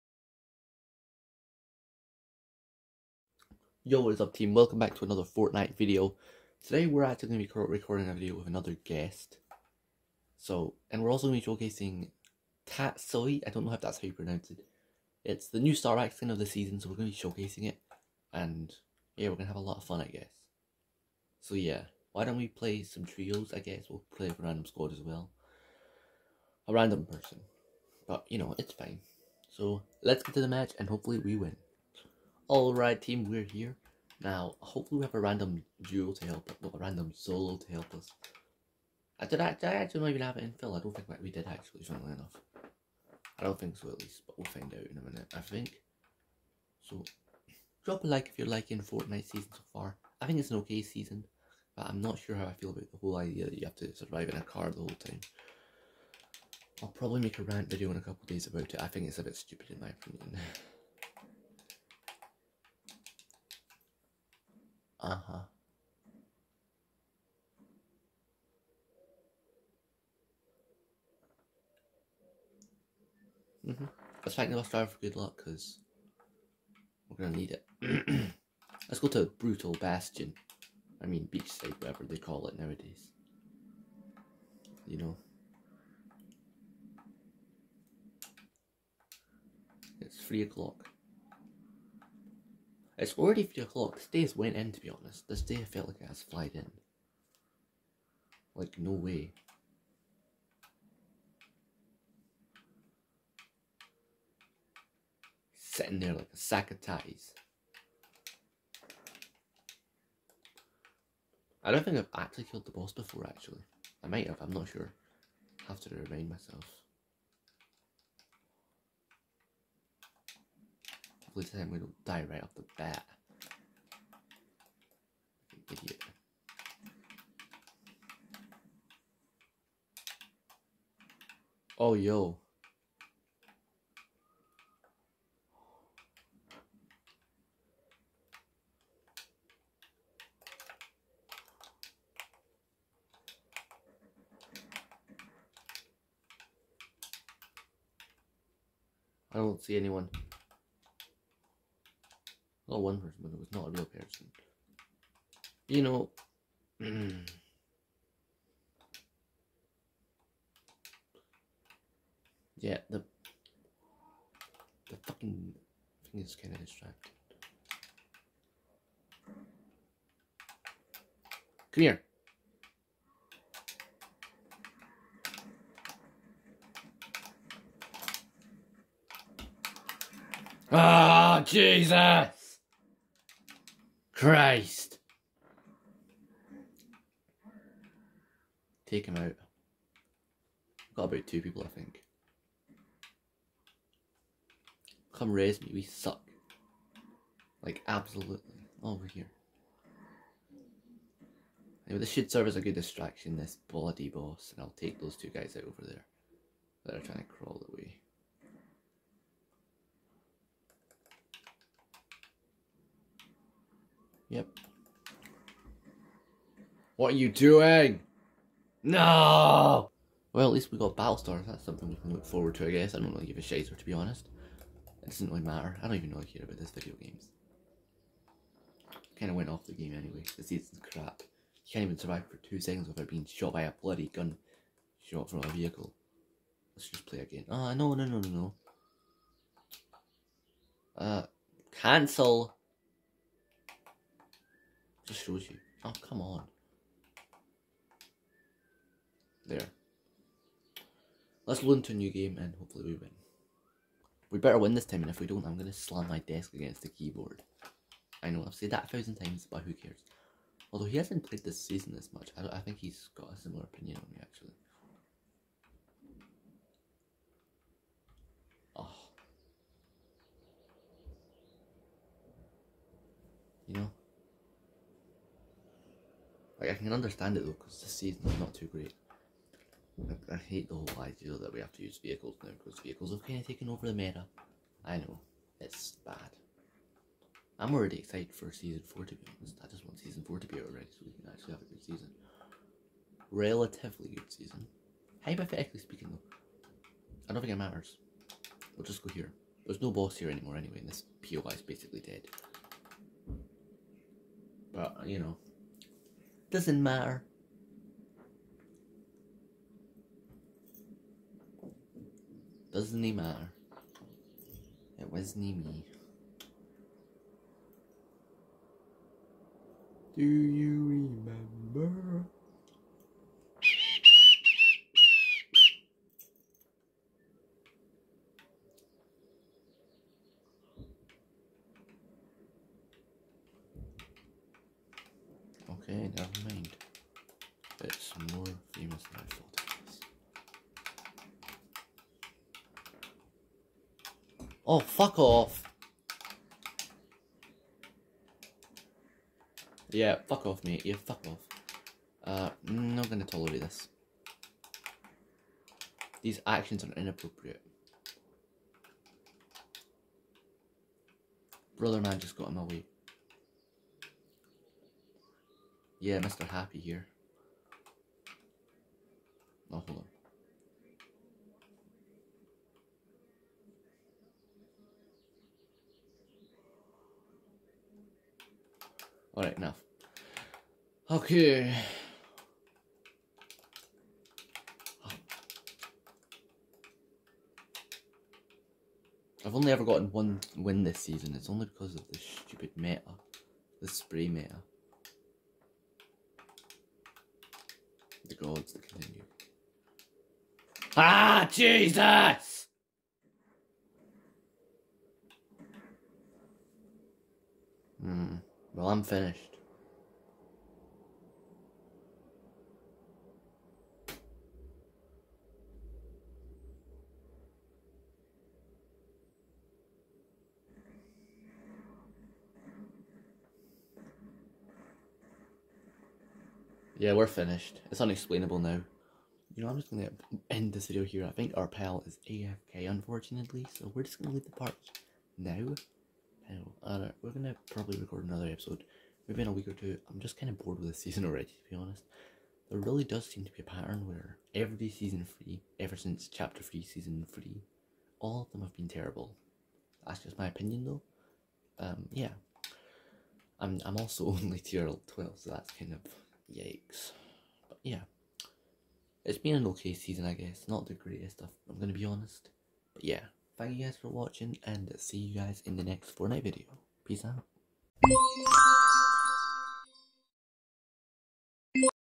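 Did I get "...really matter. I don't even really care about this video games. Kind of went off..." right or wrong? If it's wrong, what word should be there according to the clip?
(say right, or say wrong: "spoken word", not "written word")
right.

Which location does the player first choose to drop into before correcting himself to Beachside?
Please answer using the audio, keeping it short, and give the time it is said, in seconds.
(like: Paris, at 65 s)
Brutal Bastion, at 79 s.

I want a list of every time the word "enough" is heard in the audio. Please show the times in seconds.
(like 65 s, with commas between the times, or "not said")
42 s, 379 s.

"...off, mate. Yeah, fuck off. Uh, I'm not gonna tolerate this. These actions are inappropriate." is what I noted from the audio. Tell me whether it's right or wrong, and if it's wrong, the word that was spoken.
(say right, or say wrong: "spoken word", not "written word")
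right.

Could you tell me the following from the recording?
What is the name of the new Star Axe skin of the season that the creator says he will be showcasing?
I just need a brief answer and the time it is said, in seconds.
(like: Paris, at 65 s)
Tatsuo, at 12 s.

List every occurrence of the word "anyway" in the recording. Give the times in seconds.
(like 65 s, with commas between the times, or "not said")
201 s, 229 s, 300 s.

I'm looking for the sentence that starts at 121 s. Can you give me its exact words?
Hopefully this time we don't die right off the bat.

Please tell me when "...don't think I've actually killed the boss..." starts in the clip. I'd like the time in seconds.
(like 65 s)
111 s.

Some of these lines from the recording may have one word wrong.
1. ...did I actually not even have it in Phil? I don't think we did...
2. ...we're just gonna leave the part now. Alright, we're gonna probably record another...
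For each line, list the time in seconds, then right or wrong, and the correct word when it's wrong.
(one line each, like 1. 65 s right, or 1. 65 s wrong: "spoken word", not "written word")
1. 39 s right
2. 433 s right.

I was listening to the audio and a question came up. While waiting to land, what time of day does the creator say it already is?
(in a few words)
3 o'clock.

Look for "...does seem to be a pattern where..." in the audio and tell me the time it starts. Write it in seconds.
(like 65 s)
443 s.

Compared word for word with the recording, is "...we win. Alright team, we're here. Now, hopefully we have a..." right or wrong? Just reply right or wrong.
right.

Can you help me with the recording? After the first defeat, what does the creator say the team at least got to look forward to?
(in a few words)
Battlestar.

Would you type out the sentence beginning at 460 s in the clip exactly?
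Not the greatest stuff, I'm gonna be honest.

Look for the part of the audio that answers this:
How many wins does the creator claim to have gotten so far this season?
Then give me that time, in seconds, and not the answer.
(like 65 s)
390 s.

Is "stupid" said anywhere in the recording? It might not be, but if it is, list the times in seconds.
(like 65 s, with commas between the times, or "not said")
59 s, 392 s.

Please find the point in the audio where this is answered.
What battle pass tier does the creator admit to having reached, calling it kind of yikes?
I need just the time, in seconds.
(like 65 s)
454 s.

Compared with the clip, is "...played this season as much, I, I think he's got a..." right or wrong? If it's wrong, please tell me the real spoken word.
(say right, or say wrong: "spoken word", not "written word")
right.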